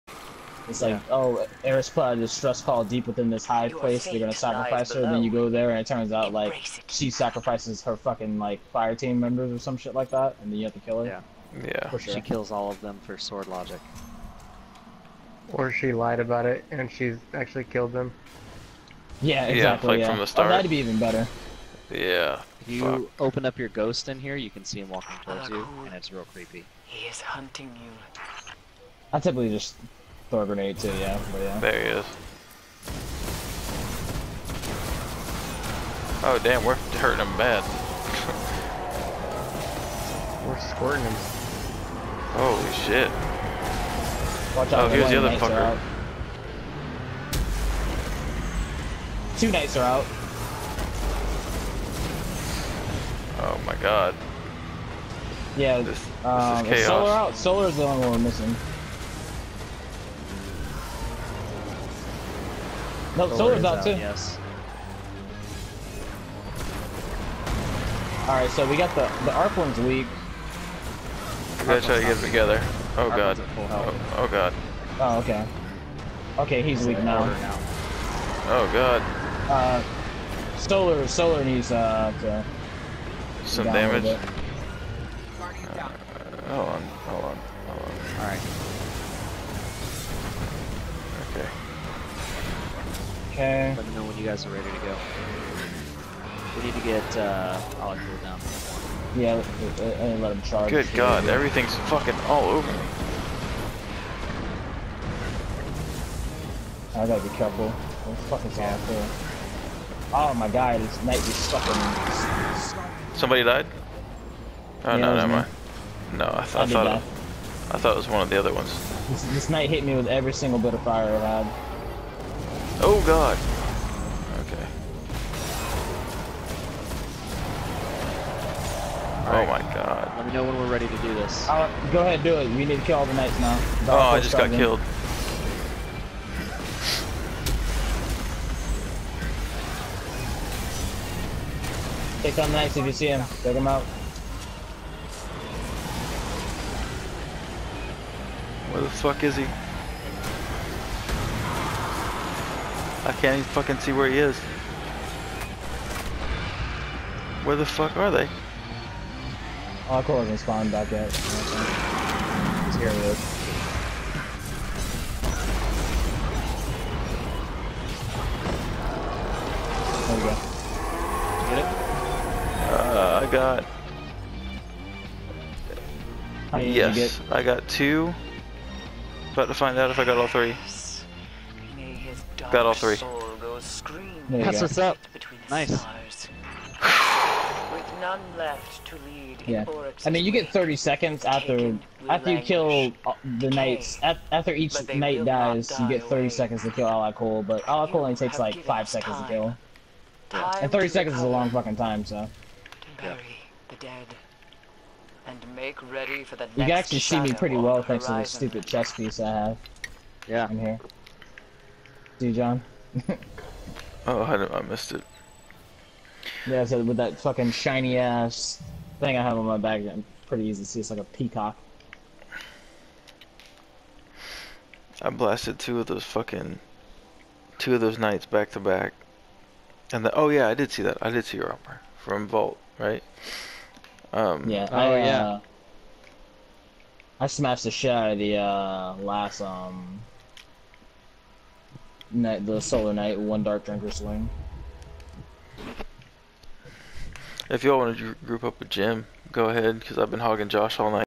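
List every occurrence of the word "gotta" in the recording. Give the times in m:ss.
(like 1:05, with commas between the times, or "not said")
1:11, 1:47.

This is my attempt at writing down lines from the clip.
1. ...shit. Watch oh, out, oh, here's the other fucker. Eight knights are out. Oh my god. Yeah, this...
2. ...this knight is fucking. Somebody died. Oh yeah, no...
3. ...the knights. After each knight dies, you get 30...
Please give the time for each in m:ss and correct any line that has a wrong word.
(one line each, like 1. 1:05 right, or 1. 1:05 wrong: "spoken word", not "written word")
1. 0:42 wrong: "Two", not "Eight"
2. 1:50 right
3. 3:13 right.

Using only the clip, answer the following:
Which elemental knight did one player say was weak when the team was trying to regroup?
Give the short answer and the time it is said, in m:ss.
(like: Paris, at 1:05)
Arc, at 1:09.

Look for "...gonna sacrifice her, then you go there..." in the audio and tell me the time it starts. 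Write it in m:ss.
0:04.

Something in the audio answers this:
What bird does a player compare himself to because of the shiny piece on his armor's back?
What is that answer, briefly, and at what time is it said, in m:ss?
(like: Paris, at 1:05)
Peacock, at 3:41.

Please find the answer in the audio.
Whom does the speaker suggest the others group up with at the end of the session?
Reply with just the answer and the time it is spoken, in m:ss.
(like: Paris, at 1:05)
Jim, at 4:08.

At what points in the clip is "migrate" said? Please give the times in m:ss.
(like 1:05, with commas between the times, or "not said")
not said.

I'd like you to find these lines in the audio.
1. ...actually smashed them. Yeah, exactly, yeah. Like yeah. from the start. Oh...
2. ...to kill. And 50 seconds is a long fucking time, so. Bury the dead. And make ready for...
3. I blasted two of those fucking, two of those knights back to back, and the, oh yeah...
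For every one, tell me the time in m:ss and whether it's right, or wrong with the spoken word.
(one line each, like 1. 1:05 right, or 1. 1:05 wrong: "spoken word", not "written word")
1. 0:17 wrong: "killed", not "smashed"
2. 3:19 wrong: "30", not "50"
3. 3:45 right.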